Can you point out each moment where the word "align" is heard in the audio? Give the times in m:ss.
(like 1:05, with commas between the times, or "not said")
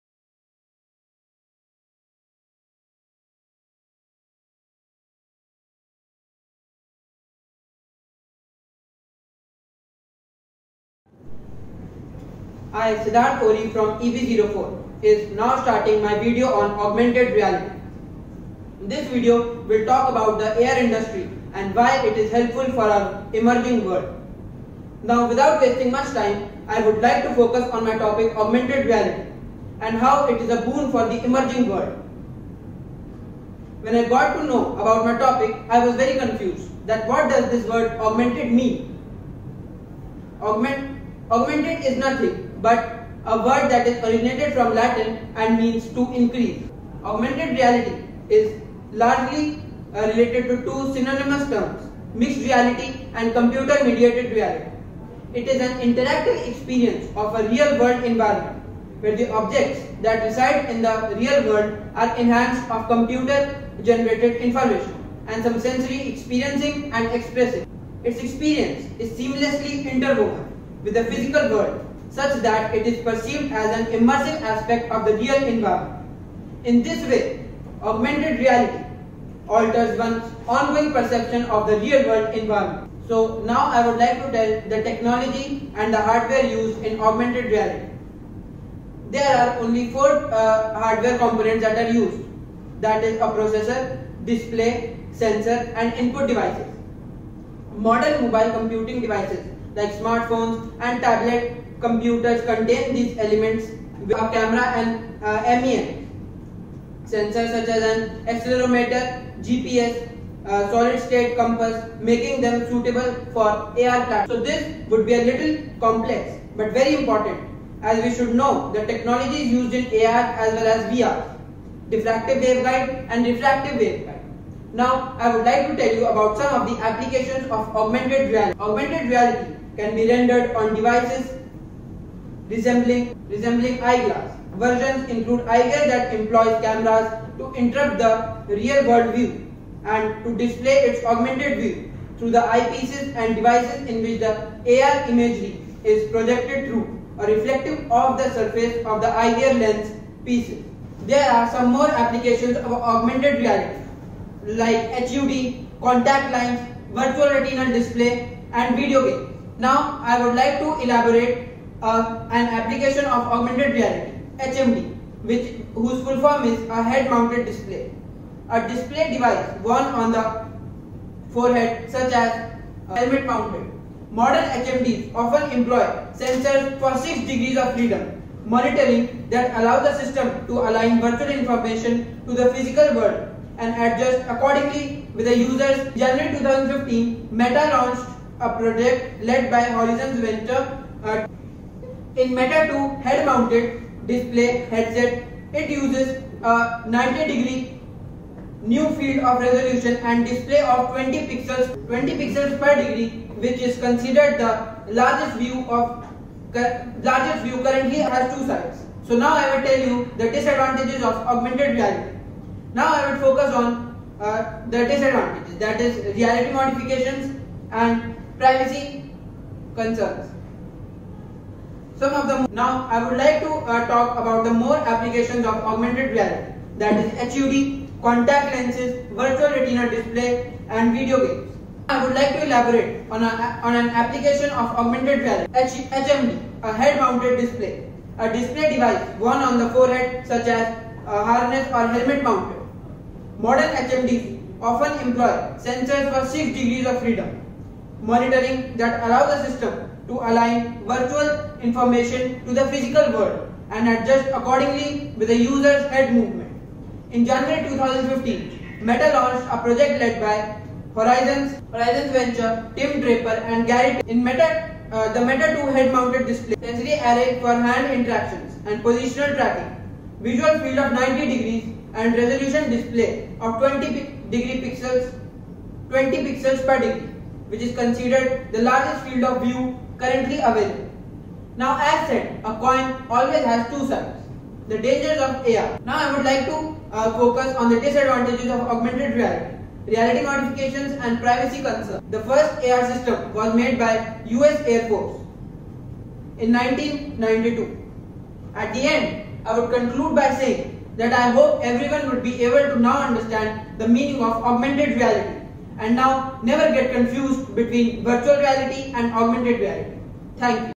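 3:00, 4:10.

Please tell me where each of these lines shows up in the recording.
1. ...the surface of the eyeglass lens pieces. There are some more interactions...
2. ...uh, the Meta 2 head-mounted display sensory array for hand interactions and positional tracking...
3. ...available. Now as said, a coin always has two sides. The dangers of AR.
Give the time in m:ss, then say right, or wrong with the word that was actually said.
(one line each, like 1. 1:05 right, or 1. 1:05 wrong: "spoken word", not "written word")
1. 2:28 wrong: "applications", not "interactions"
2. 4:24 right
3. 4:40 right.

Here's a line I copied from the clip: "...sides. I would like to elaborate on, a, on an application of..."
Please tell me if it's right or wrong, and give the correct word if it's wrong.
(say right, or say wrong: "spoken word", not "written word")
wrong: "games", not "sides".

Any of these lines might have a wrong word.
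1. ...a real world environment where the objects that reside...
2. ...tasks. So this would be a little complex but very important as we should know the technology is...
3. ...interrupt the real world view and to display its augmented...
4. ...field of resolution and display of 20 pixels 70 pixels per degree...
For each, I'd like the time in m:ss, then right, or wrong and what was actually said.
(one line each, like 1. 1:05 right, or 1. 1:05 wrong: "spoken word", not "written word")
1. 0:57 right
2. 1:53 right
3. 2:17 right
4. 3:18 wrong: "20", not "70".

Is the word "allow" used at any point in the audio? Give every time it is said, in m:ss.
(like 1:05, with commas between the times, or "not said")
2:59, 4:09.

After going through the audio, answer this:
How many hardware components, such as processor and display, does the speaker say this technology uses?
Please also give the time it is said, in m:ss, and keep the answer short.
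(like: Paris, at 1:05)
4, at 1:29.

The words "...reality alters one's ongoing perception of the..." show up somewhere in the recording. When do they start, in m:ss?
1:18.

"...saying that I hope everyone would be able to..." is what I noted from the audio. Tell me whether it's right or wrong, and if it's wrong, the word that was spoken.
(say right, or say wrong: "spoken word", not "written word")
right.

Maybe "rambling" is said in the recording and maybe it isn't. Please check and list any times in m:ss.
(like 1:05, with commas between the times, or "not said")
not said.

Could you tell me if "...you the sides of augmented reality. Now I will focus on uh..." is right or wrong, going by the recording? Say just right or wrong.
wrong.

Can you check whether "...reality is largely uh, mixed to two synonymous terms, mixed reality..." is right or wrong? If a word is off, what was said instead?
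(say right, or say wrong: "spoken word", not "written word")
wrong: "related", not "mixed".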